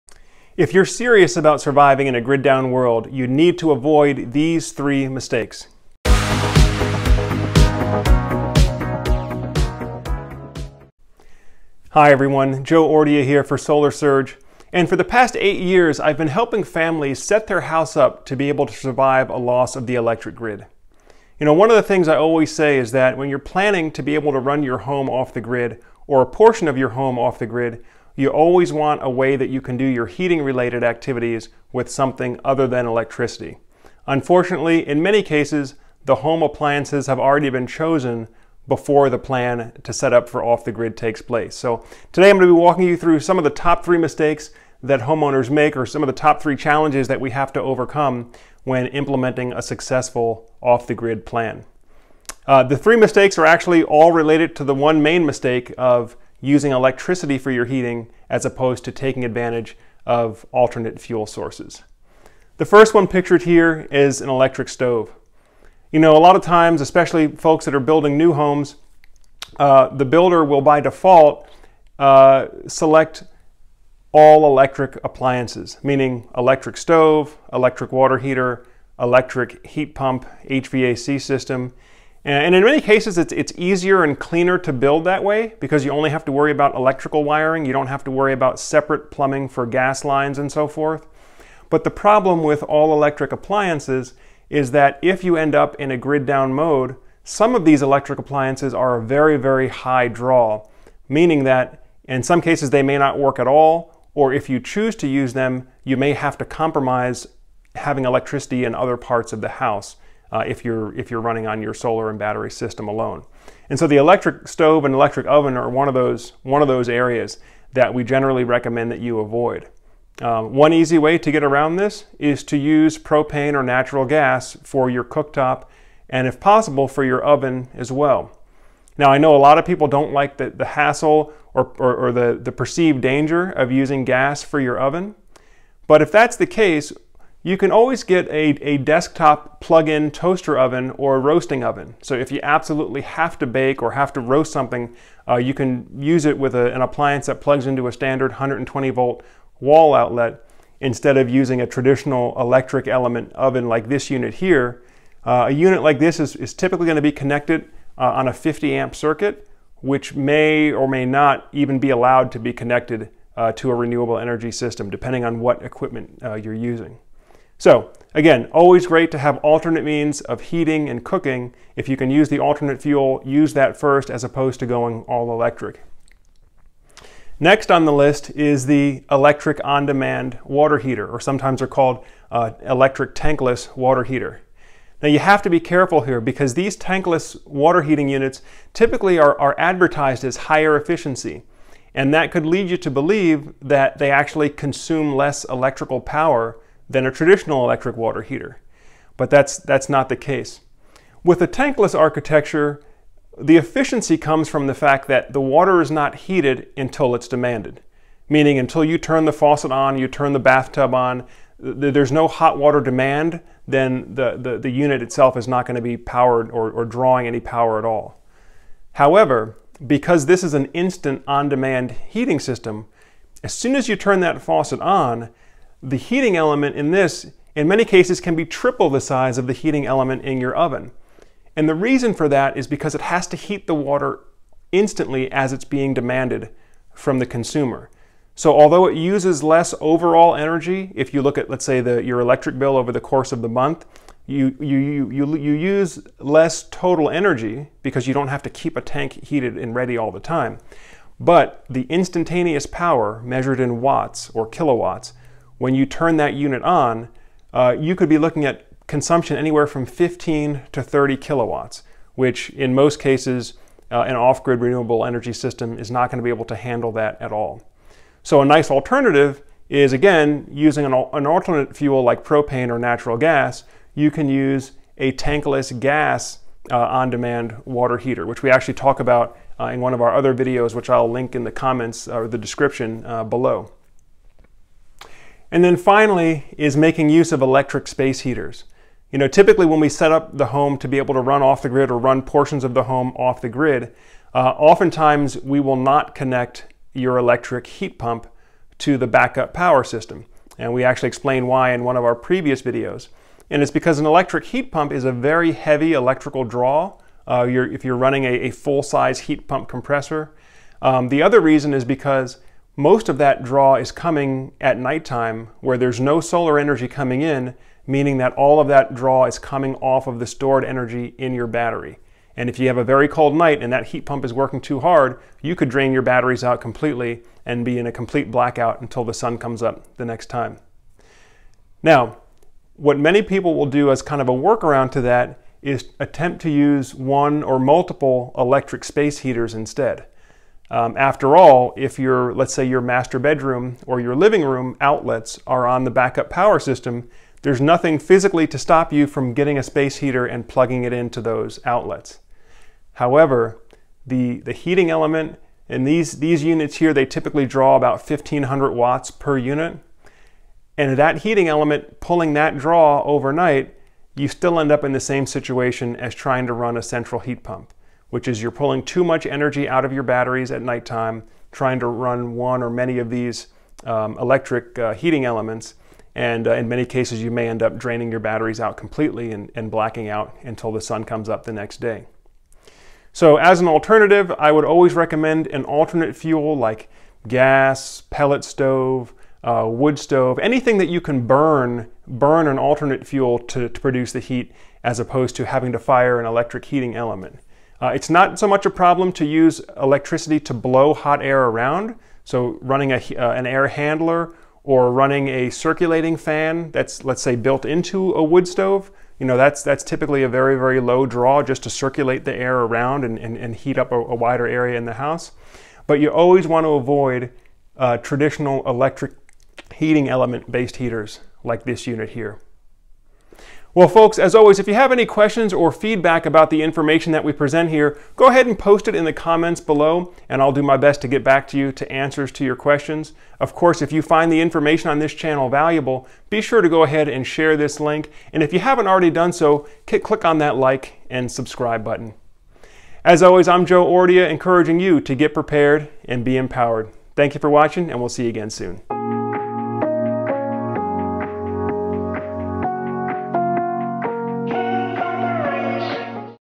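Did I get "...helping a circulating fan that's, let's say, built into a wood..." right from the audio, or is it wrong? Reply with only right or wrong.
wrong.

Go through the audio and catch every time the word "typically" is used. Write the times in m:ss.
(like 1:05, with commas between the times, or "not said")
2:36, 3:08, 4:49, 5:57, 6:49.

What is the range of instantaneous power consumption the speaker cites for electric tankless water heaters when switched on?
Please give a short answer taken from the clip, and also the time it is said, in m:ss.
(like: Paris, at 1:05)
15 to 30 kilowatts, at 4:19.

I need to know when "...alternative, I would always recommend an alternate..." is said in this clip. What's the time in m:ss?
6:23.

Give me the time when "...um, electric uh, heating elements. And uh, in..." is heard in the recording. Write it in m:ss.
6:13.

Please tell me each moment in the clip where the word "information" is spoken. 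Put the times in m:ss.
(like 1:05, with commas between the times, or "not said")
7:06, 7:14.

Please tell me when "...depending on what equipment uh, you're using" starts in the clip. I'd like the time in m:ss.
2:44.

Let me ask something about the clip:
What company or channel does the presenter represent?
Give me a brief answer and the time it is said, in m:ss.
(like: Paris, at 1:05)
Solar Surge, at 0:13.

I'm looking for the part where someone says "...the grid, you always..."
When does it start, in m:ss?
0:27.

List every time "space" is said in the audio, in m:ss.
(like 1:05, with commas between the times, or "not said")
4:47, 5:38, 5:49.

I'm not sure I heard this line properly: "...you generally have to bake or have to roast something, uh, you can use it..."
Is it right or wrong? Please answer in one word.
wrong.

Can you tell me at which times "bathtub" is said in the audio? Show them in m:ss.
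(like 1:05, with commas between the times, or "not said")
3:30.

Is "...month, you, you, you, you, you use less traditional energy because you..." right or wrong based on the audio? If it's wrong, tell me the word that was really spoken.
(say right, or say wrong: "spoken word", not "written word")
wrong: "total", not "traditional".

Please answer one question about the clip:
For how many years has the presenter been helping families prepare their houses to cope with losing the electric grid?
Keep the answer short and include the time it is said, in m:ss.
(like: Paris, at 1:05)
8, at 0:15.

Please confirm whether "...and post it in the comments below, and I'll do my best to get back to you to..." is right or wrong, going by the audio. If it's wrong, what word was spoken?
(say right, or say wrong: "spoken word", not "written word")
right.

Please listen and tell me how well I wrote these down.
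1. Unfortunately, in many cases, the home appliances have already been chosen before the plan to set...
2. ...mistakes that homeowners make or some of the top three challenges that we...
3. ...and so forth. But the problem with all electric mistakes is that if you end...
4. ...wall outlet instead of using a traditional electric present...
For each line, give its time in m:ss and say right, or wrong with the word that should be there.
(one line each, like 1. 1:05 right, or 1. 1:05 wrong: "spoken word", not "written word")
1. 0:34 right
2. 0:43 right
3. 1:30 wrong: "appliances", not "mistakes"
4. 2:29 wrong: "element", not "present".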